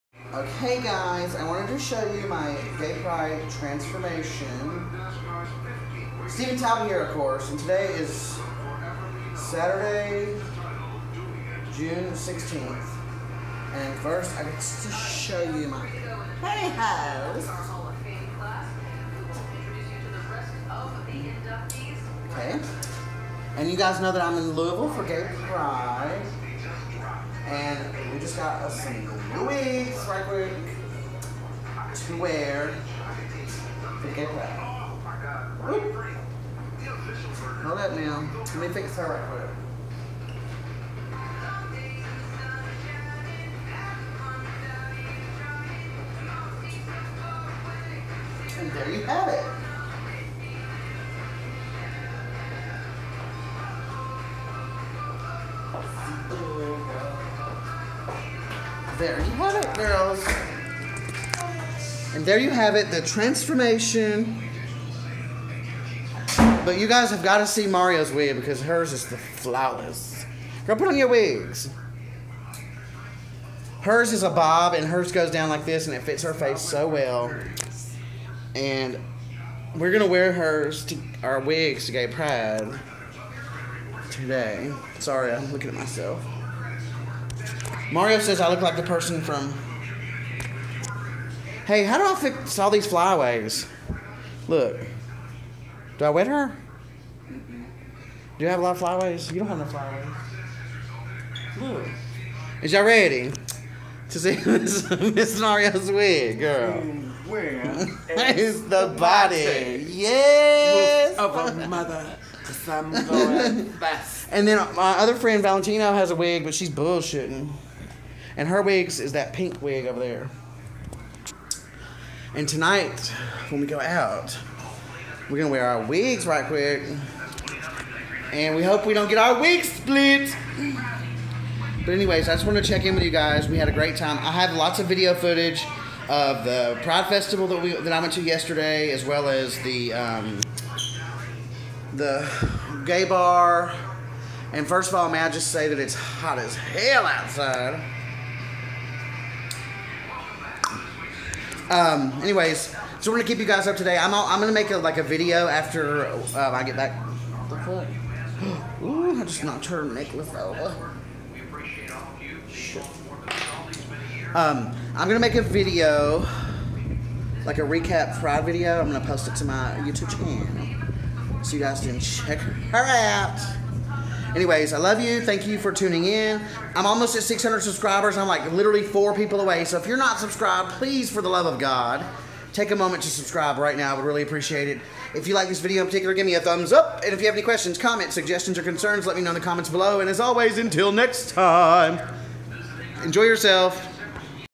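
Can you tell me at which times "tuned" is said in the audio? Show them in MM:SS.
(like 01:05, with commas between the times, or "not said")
not said.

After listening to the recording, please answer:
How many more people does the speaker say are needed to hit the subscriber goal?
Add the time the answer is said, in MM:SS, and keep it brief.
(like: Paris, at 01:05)
4, at 02:58.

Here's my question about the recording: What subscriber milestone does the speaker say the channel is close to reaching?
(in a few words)
600.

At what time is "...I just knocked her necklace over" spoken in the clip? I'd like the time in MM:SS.
02:39.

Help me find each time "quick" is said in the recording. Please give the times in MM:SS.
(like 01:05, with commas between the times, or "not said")
00:30, 00:39, 02:06.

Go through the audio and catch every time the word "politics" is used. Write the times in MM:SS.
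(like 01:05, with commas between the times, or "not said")
not said.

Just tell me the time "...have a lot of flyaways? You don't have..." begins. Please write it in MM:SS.
01:38.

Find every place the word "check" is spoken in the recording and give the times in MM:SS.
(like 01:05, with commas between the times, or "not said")
02:12, 02:52.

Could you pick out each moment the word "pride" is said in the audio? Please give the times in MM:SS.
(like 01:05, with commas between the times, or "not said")
00:03, 00:25, 01:22, 02:16, 02:48.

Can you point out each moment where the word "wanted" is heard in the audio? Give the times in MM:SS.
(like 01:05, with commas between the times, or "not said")
00:01, 02:12.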